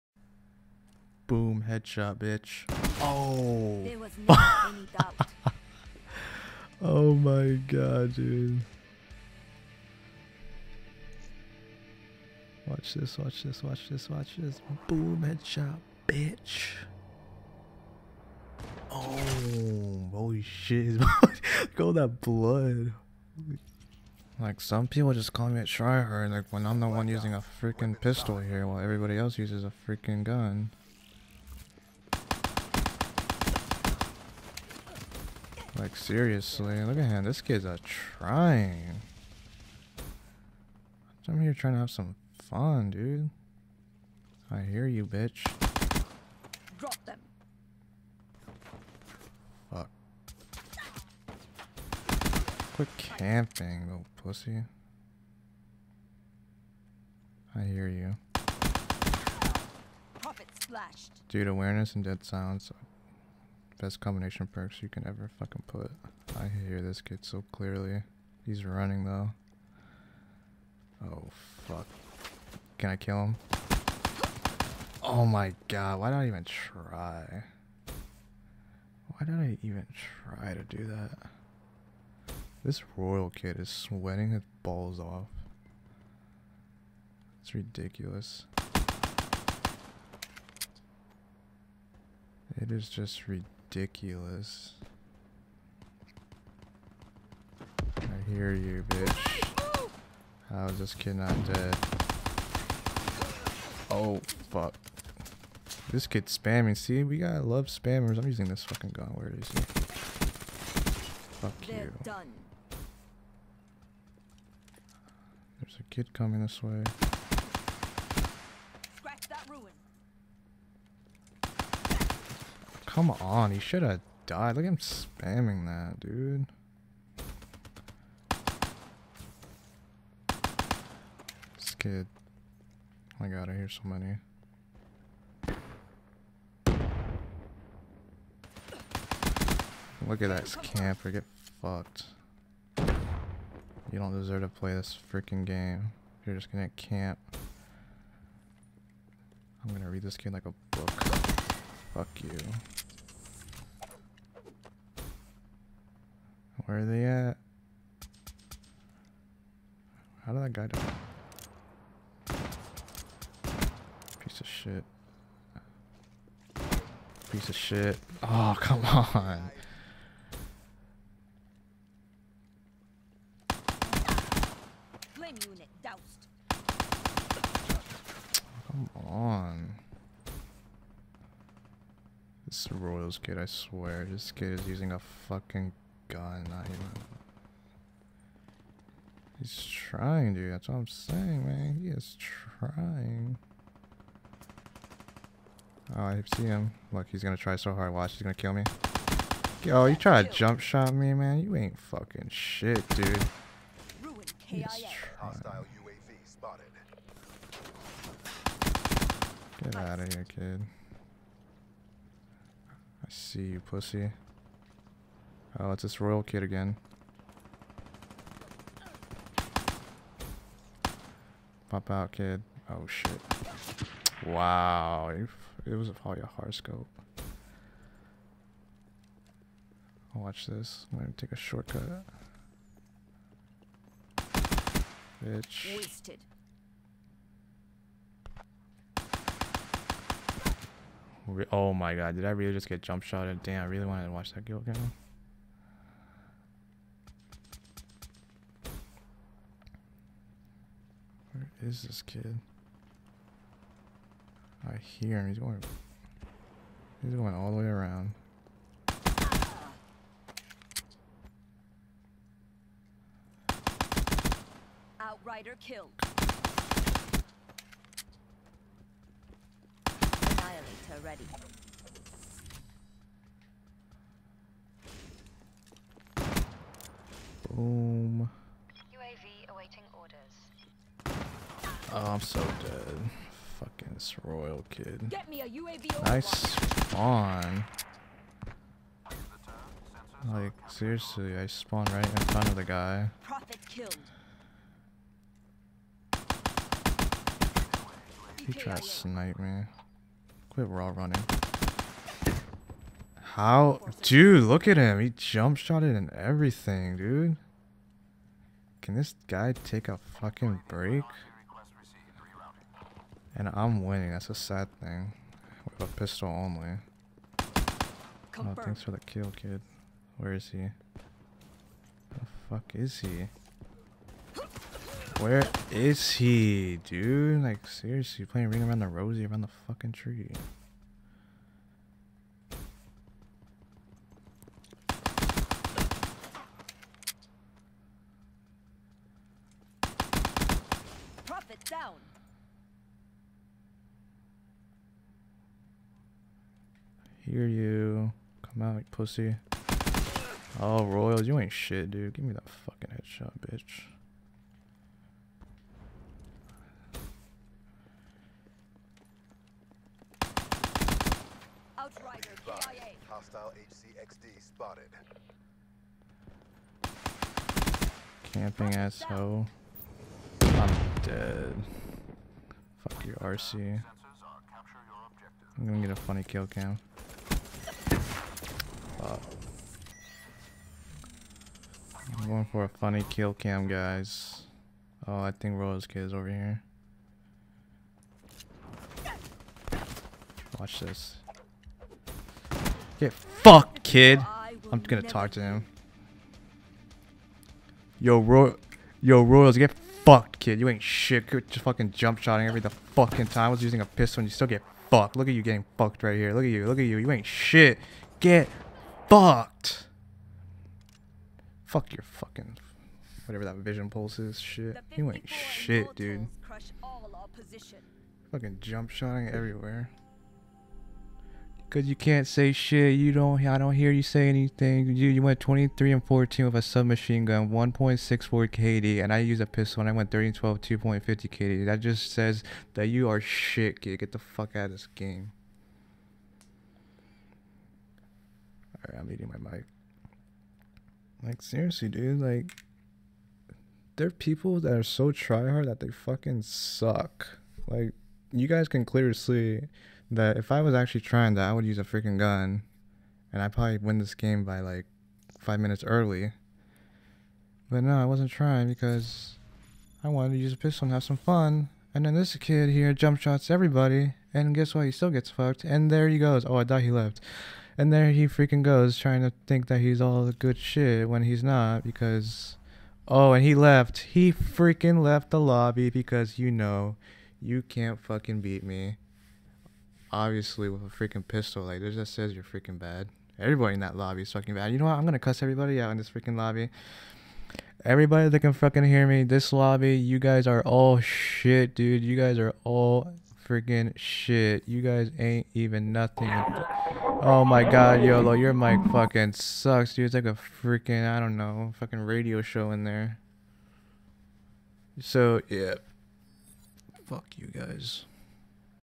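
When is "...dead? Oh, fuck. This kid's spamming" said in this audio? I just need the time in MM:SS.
01:41.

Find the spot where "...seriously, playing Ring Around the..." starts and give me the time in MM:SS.
05:27.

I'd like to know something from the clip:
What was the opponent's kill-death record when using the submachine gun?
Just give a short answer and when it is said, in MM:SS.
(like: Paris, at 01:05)
23 and 14, at 07:05.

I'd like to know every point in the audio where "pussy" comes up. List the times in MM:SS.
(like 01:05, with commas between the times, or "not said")
00:54, 03:33, 05:48.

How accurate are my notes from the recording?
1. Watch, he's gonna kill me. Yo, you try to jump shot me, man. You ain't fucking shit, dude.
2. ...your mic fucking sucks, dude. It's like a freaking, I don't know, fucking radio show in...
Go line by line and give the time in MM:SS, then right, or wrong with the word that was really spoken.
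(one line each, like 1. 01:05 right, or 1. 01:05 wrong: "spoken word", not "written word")
1. 03:17 right
2. 08:18 right.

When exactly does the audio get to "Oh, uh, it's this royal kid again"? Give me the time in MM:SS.
03:35.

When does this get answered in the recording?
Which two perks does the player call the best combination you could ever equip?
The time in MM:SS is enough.
01:01.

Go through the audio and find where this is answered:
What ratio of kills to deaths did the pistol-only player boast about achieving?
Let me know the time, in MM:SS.
07:10.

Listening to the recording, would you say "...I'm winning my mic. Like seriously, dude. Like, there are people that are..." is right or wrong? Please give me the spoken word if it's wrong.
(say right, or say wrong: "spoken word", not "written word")
wrong: "eating", not "winning".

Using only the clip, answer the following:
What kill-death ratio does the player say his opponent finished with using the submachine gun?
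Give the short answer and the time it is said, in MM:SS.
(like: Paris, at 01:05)
1.64, at 07:07.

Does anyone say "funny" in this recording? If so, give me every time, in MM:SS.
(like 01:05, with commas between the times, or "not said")
06:15, 06:22.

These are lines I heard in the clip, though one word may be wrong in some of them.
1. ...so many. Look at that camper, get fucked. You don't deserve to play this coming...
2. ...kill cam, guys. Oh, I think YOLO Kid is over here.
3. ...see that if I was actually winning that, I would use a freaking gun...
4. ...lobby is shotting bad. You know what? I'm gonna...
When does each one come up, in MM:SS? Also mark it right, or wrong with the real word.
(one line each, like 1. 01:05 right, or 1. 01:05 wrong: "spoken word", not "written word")
1. 02:13 wrong: "freaking", not "coming"
2. 06:23 wrong: "Rose", not "YOLO"
3. 07:29 wrong: "trying", not "winning"
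4. 08:03 wrong: "fucking", not "shotting".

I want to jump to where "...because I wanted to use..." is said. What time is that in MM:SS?
07:38.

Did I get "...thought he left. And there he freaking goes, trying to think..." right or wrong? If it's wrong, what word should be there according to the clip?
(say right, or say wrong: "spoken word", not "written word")
right.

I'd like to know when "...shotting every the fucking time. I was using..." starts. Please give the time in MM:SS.
06:42.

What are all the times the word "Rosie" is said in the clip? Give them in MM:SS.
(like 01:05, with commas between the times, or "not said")
05:28.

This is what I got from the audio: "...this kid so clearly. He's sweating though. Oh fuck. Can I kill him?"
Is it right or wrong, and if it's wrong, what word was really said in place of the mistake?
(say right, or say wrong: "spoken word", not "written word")
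wrong: "running", not "sweating".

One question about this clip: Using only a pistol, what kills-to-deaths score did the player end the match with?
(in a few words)
30 and 12.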